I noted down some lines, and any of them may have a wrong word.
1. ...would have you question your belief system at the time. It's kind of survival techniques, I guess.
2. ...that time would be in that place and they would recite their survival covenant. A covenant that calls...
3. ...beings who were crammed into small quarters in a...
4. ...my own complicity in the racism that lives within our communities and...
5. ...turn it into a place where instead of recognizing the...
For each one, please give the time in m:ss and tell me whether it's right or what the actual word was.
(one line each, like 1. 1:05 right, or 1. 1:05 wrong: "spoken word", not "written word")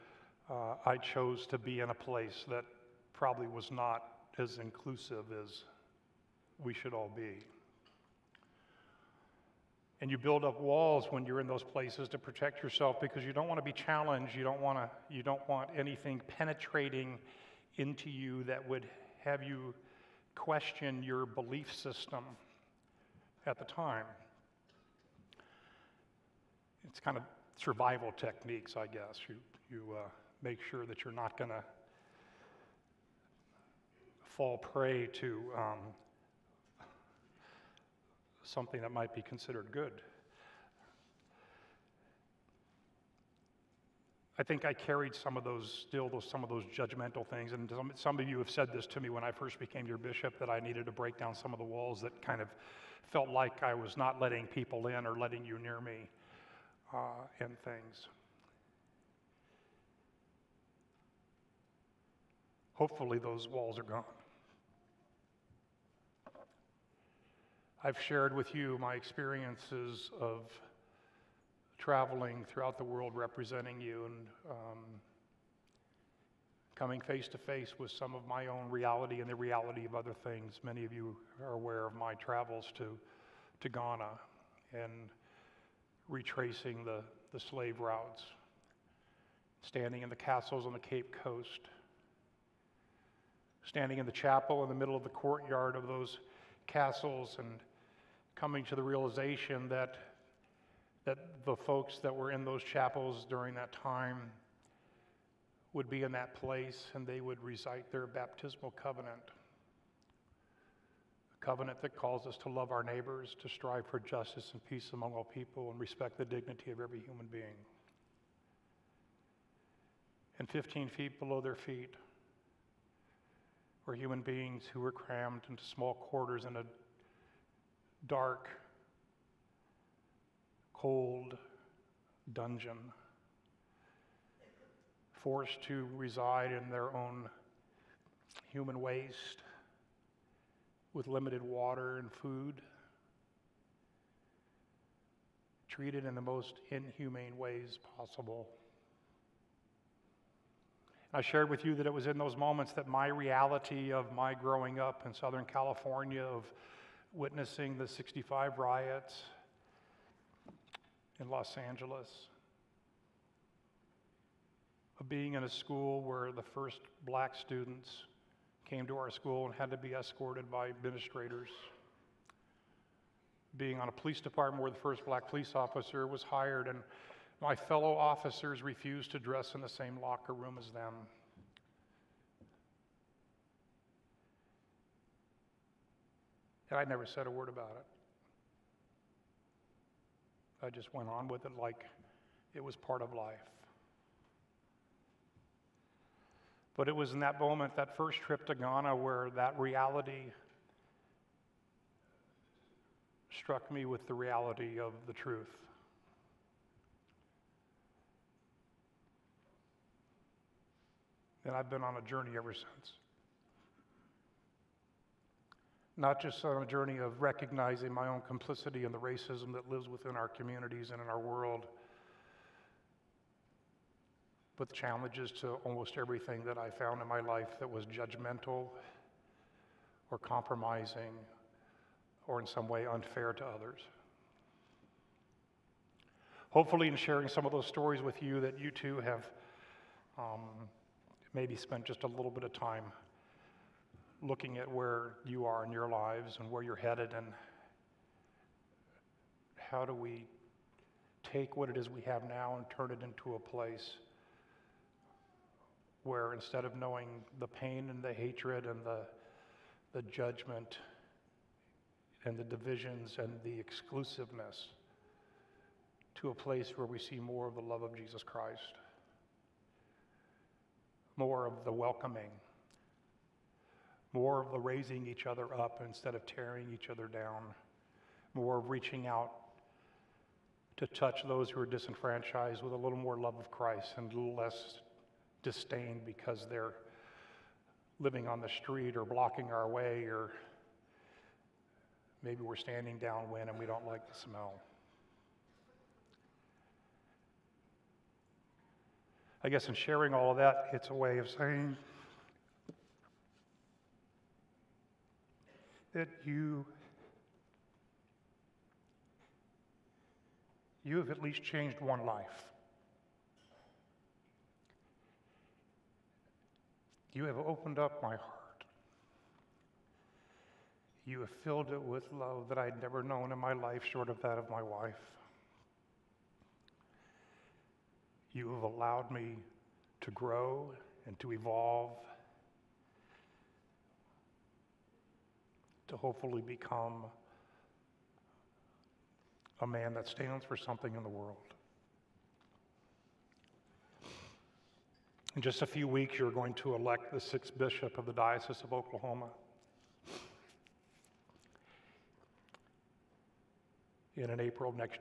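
1. 0:18 right
2. 1:43 wrong: "baptismal", not "survival"
3. 2:04 right
4. 3:37 right
5. 4:12 wrong: "knowing", not "recognizing".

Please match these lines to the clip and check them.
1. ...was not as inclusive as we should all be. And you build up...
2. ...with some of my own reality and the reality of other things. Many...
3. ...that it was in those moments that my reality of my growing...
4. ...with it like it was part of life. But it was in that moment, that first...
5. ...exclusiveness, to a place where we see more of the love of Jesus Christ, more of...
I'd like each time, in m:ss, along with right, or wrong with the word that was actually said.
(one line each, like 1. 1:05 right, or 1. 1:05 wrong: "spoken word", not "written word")
1. 0:03 right
2. 1:17 right
3. 2:31 right
4. 3:11 right
5. 4:23 right.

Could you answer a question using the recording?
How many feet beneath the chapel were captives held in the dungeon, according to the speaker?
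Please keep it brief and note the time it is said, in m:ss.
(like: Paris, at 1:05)
15, at 2:00.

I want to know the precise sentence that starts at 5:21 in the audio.
You have filled it with love that I had never known in my life, short of that of my wife.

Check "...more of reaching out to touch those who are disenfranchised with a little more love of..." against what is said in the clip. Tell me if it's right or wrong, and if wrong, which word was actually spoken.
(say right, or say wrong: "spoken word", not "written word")
right.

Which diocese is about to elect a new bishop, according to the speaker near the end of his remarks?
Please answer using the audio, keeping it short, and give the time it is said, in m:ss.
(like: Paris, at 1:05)
Diocese of Oklahoma, at 5:48.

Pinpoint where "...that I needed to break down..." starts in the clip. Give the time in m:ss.
0:50.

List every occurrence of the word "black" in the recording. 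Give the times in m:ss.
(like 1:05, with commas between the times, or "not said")
2:47, 2:55.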